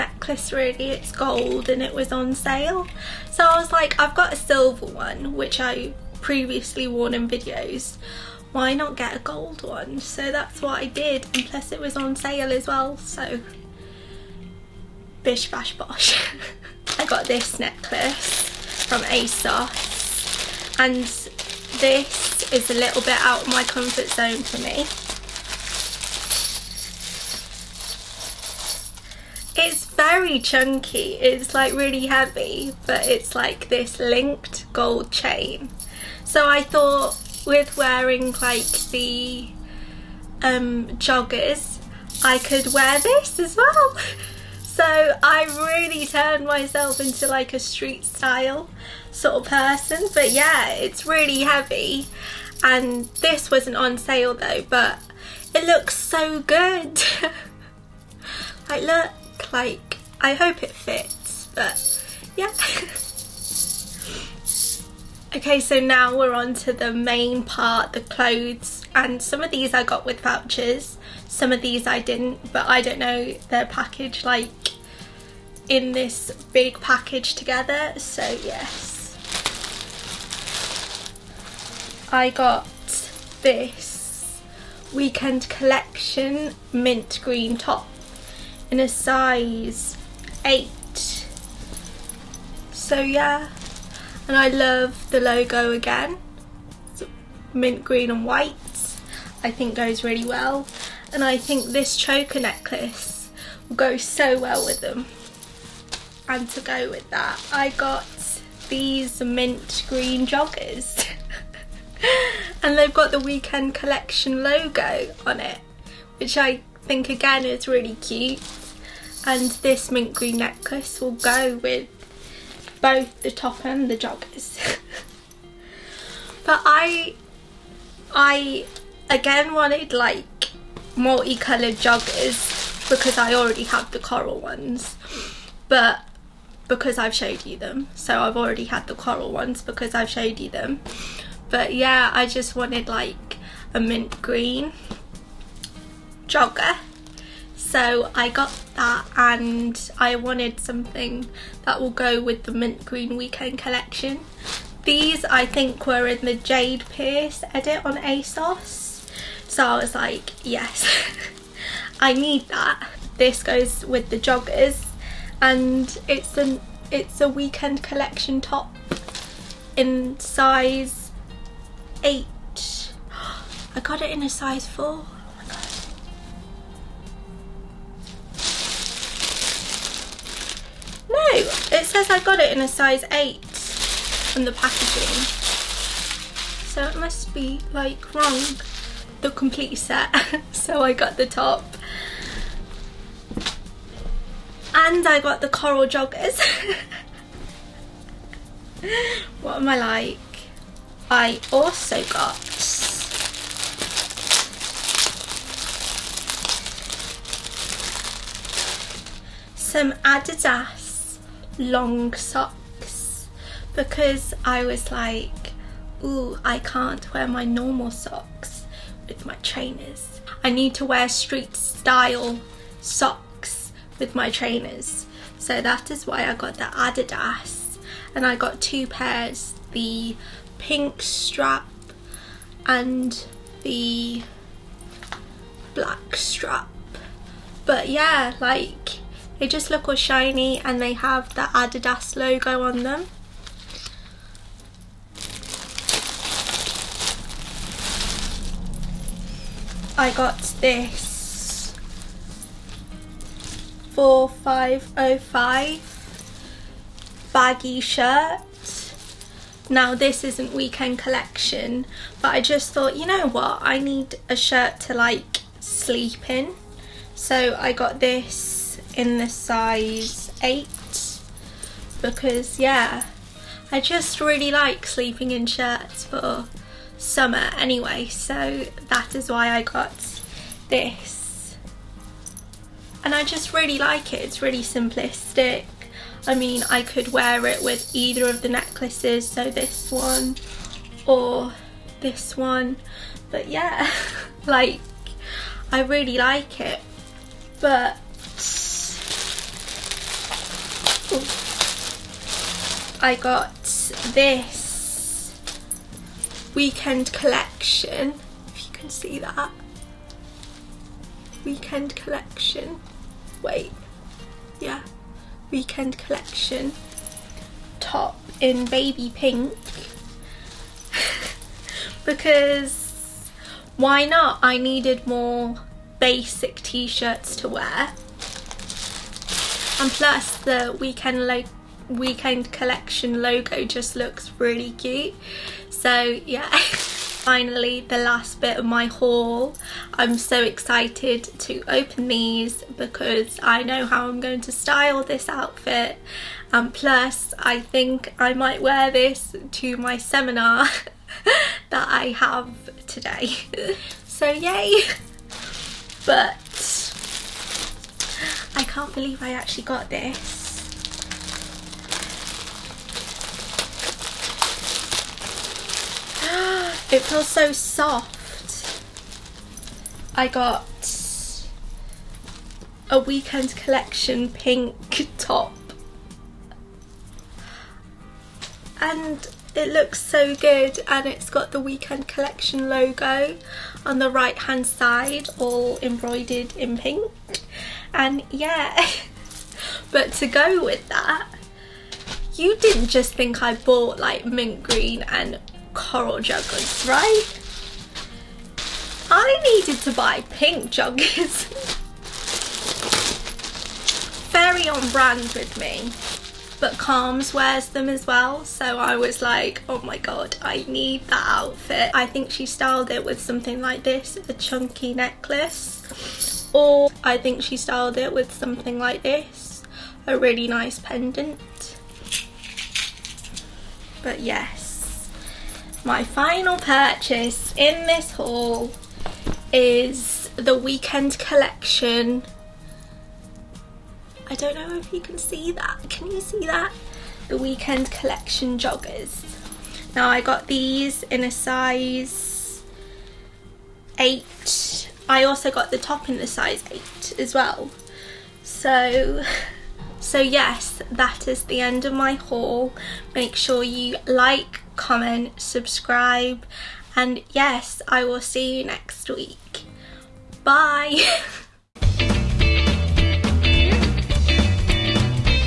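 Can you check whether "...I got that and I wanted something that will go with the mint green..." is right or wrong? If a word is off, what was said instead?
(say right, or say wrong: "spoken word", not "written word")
right.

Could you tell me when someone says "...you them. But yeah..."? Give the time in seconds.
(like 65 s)
140 s.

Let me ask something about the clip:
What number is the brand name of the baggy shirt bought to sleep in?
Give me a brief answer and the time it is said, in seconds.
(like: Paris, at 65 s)
4505, at 253 s.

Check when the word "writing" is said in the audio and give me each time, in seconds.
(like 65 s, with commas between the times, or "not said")
not said.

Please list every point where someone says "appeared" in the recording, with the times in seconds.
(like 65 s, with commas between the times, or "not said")
not said.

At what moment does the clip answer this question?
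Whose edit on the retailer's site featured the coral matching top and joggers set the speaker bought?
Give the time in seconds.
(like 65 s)
156 s.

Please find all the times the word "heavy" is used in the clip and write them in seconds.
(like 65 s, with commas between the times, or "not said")
32 s, 51 s.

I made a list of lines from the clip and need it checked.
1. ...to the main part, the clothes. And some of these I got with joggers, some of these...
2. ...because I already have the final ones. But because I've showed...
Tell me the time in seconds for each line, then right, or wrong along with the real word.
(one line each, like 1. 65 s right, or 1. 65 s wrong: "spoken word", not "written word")
1. 66 s wrong: "vouchers", not "joggers"
2. 132 s wrong: "coral", not "final".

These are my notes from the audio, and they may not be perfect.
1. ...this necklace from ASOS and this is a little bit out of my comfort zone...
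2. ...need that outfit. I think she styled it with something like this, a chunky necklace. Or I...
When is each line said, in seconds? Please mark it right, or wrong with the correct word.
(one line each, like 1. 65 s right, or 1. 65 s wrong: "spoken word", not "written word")
1. 17 s right
2. 410 s right.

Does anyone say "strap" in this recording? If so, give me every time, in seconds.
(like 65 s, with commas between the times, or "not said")
231 s, 236 s.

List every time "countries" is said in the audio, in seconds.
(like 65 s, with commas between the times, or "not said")
not said.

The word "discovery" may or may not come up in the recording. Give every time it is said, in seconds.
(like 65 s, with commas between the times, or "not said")
not said.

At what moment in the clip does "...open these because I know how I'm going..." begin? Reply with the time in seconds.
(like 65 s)
341 s.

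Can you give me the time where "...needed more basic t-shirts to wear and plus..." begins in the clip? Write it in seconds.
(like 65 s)
324 s.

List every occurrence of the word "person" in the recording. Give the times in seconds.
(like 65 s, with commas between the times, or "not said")
49 s.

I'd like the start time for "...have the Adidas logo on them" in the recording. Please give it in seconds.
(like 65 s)
240 s.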